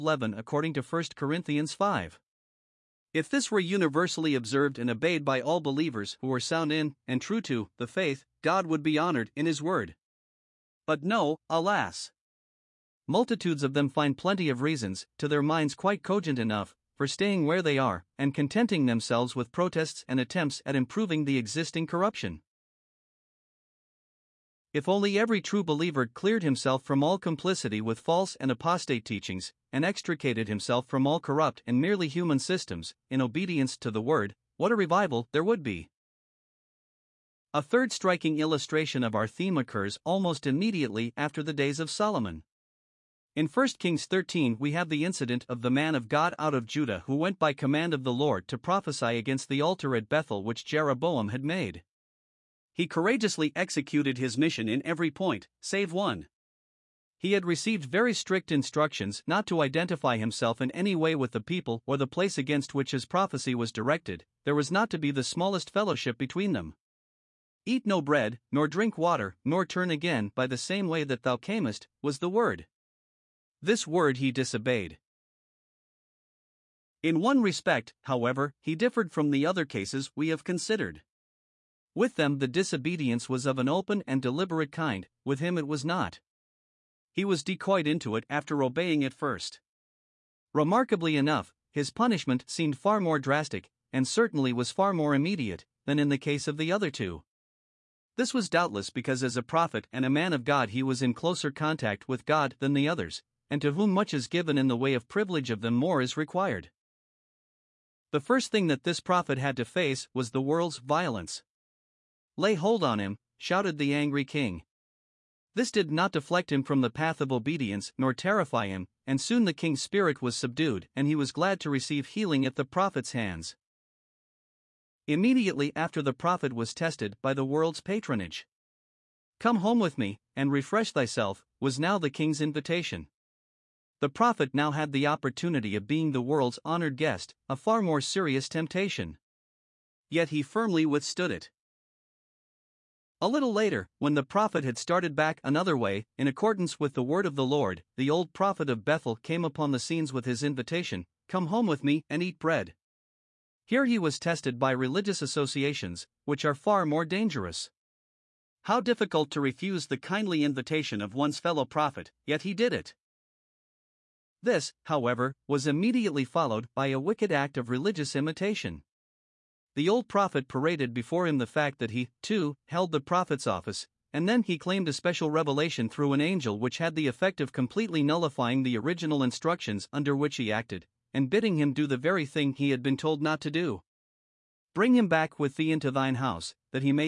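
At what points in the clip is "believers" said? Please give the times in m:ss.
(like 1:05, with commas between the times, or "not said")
0:05, 0:25.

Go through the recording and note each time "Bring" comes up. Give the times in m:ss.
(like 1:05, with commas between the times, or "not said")
3:04.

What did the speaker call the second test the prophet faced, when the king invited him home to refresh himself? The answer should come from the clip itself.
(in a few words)
the world's patronage.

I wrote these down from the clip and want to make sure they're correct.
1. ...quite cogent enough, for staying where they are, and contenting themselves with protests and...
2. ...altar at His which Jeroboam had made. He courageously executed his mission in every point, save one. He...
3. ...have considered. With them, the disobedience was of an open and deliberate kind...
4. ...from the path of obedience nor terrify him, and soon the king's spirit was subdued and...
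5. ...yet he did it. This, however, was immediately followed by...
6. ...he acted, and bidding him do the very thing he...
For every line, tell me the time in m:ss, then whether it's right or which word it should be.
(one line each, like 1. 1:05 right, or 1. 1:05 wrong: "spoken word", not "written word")
1. 0:15 right
2. 0:49 wrong: "Bethel", not "His"
3. 1:20 right
4. 1:56 right
5. 2:42 right
6. 3:00 right.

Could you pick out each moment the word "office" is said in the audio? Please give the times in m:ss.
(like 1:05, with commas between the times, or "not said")
2:53.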